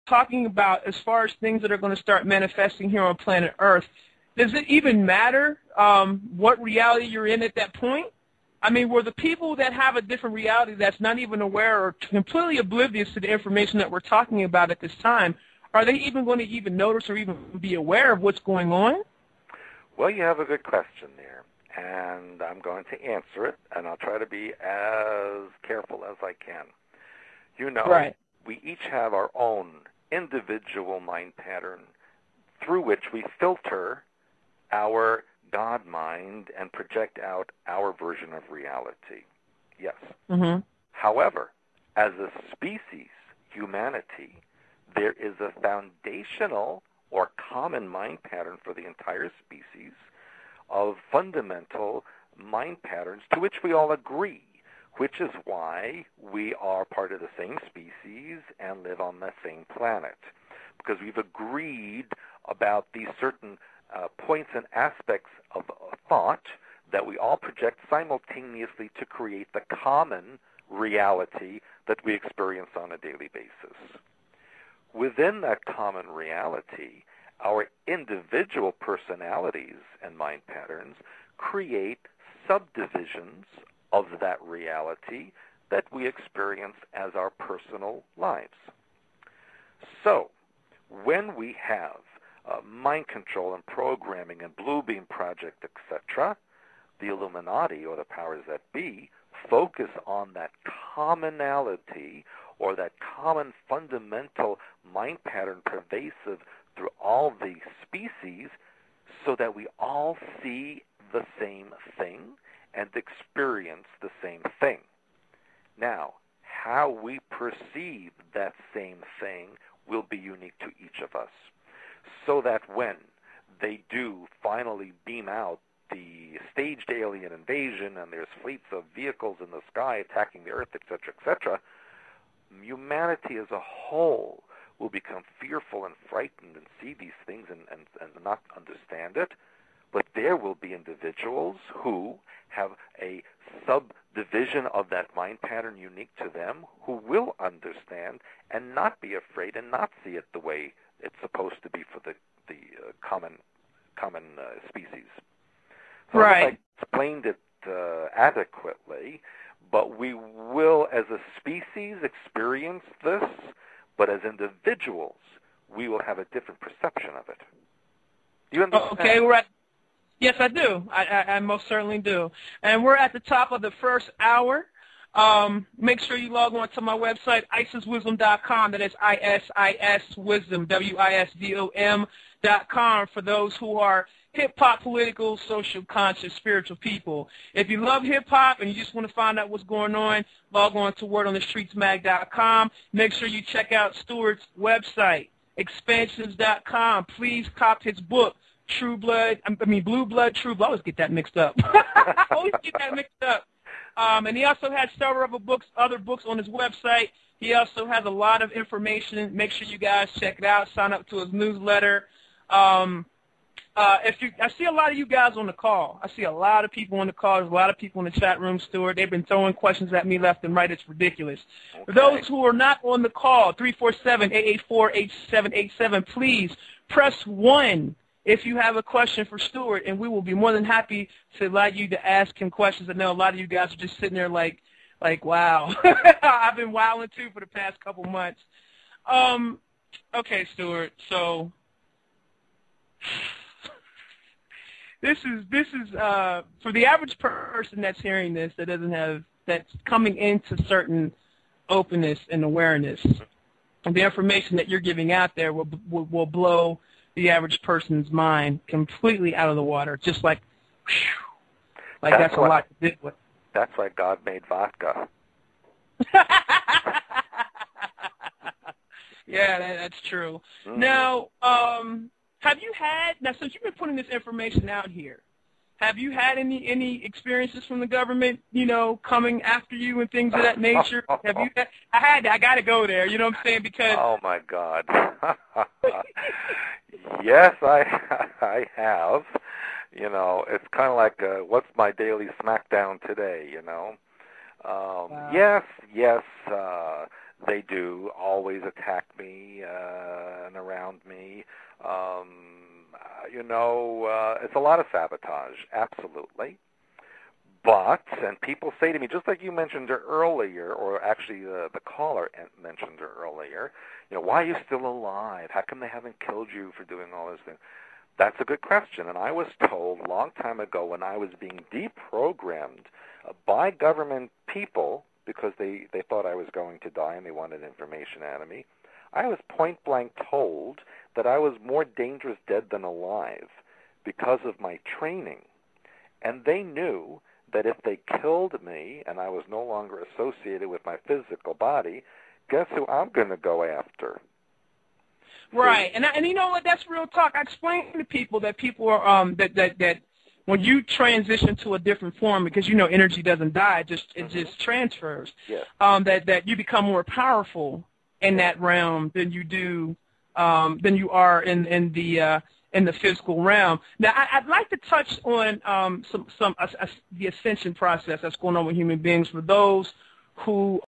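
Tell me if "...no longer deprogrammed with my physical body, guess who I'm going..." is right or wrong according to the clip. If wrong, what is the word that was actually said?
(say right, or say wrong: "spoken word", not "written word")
wrong: "associated", not "deprogrammed".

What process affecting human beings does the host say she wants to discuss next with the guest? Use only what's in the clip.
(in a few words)
ascension process.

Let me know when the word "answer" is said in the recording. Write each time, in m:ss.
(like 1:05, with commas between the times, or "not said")
0:23.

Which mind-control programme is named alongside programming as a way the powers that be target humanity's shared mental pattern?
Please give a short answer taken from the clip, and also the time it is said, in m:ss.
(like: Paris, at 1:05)
Blue Beam Project, at 1:34.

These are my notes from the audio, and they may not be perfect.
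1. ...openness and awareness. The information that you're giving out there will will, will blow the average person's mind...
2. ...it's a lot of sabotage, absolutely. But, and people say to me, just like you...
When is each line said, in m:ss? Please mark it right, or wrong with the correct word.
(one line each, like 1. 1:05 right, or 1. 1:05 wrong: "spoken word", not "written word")
1. 4:11 right
2. 5:04 right.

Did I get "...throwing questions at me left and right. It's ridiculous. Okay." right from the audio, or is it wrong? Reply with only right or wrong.
right.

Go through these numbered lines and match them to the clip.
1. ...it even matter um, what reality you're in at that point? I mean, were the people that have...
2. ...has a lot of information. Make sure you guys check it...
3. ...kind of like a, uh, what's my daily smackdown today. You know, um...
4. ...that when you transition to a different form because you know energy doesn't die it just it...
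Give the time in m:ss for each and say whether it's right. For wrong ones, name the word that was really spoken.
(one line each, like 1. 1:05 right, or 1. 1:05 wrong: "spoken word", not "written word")
1. 0:04 right
2. 3:27 right
3. 4:50 right
4. 5:49 right.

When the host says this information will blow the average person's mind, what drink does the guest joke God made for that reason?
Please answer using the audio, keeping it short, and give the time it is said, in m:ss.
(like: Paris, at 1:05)
vodka, at 4:24.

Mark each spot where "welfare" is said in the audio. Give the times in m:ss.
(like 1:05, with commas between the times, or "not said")
not said.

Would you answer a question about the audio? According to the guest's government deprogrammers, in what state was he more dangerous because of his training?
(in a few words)
dead than alive.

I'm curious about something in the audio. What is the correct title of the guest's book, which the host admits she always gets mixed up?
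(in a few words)
Blue Blood, True Blood.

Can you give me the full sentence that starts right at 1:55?
Now, how we perceive that same thing will be unique to each of us.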